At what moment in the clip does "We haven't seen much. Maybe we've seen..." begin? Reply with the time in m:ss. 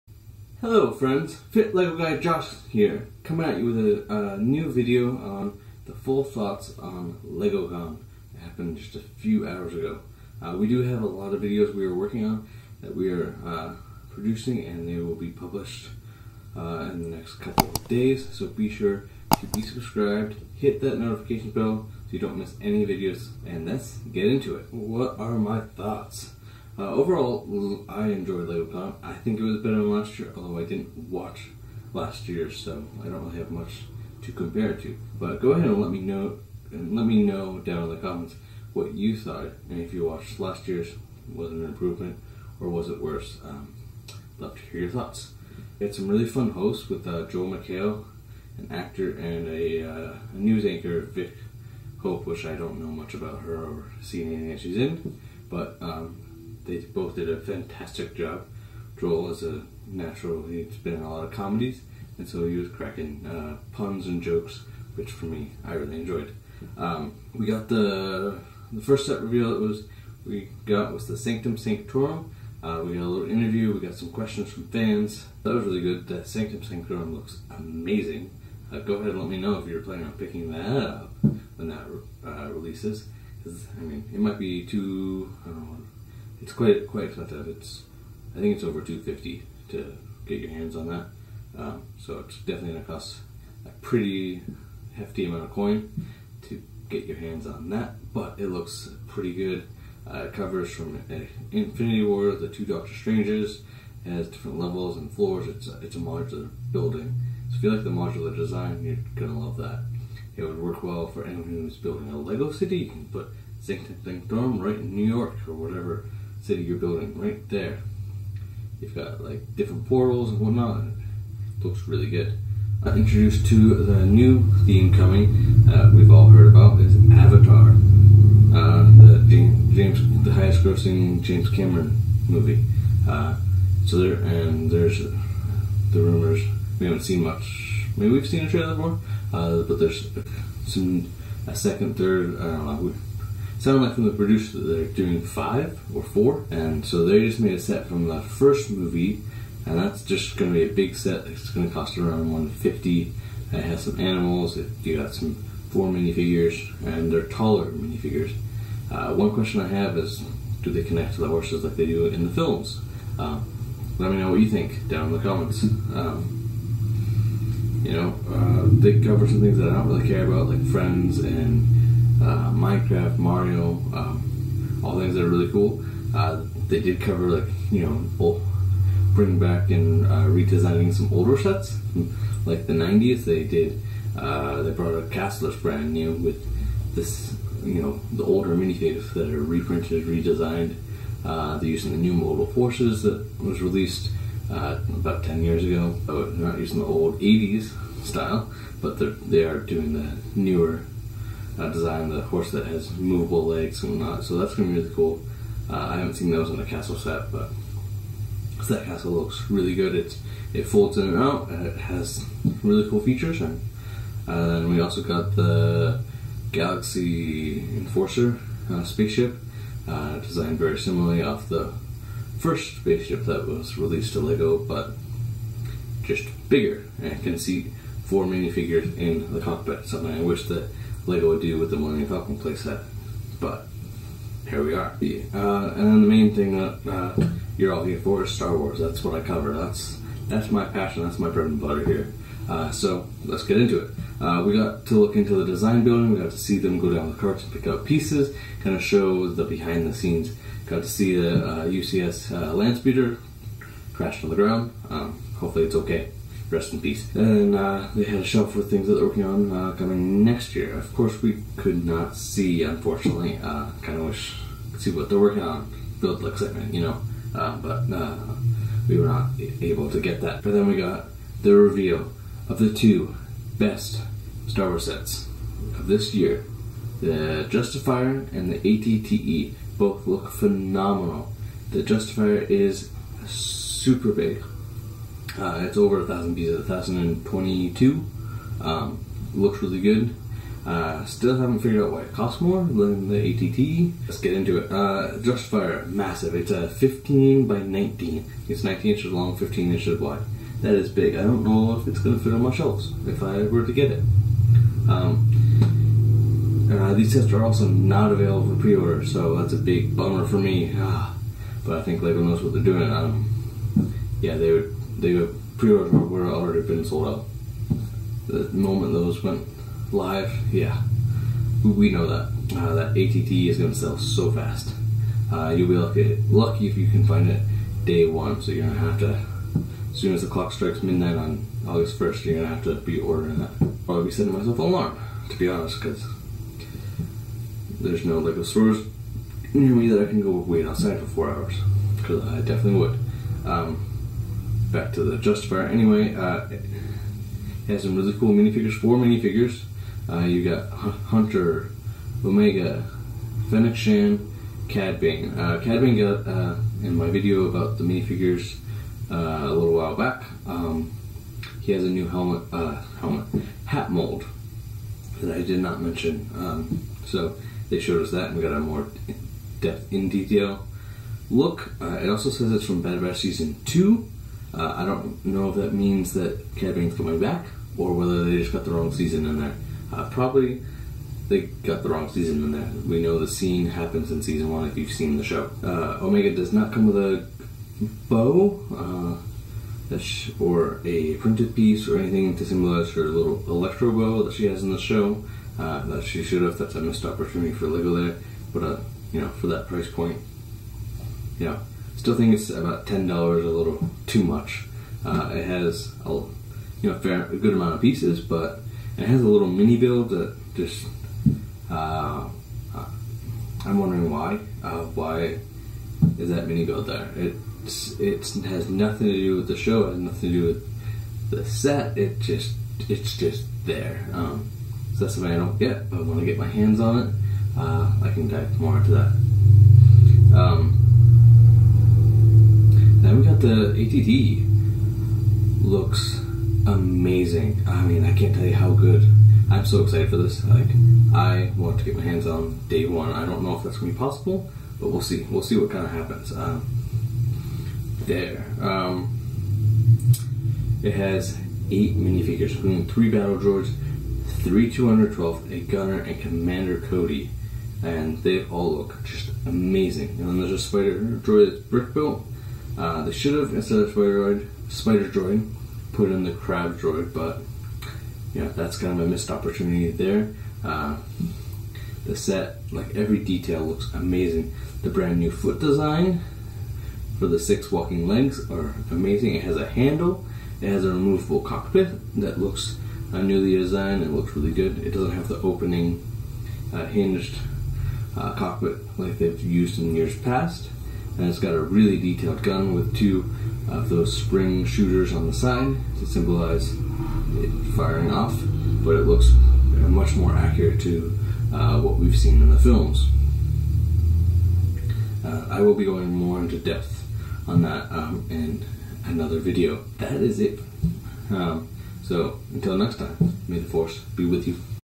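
2:16.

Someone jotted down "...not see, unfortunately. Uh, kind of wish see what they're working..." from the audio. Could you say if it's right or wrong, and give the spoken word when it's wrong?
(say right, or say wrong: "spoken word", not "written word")
right.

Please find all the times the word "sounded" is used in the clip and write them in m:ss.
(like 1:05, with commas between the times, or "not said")
2:23.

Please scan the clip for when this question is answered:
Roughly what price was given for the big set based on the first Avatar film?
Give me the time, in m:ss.
2:32.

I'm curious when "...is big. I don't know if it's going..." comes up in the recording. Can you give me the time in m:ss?
5:00.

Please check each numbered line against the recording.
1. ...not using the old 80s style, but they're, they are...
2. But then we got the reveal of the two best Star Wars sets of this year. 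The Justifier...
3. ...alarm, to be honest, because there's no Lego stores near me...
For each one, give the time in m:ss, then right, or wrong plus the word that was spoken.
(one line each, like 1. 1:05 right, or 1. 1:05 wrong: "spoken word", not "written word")
1. 3:16 right
2. 4:30 right
3. 5:34 right.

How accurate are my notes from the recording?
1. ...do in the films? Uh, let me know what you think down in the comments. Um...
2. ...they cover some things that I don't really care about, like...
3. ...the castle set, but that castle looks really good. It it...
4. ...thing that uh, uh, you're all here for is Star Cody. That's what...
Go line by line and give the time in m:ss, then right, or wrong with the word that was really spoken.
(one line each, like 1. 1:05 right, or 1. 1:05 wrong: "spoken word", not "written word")
1. 2:41 right
2. 2:48 right
3. 3:26 right
4. 3:56 wrong: "Wars", not "Cody".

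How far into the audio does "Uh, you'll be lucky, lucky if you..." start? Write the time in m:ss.
5:25.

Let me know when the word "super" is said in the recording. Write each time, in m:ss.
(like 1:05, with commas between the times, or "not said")
4:43.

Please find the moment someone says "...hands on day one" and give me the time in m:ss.
7:22.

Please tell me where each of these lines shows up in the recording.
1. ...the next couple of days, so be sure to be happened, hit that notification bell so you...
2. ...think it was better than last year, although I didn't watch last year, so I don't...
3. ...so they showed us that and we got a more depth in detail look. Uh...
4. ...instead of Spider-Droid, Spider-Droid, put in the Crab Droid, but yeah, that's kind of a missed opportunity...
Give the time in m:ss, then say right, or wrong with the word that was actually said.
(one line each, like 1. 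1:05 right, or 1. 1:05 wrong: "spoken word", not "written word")
1. 0:17 wrong: "subscribed", not "happened"
2. 0:29 right
3. 6:07 right
4. 7:43 right.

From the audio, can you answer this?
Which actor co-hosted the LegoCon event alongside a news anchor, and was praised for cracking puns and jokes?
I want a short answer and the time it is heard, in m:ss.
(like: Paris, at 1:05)
Joel McHale, at 0:47.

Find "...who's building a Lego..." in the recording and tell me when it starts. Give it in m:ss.
1:51.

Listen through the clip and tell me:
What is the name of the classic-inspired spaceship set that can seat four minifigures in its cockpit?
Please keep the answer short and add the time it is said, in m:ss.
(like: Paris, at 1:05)
Galaxy Enforcer, at 3:36.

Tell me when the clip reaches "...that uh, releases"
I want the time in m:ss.
1:21.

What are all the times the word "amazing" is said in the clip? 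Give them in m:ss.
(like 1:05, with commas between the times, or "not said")
1:17, 7:16, 7:39, 7:53, 7:58.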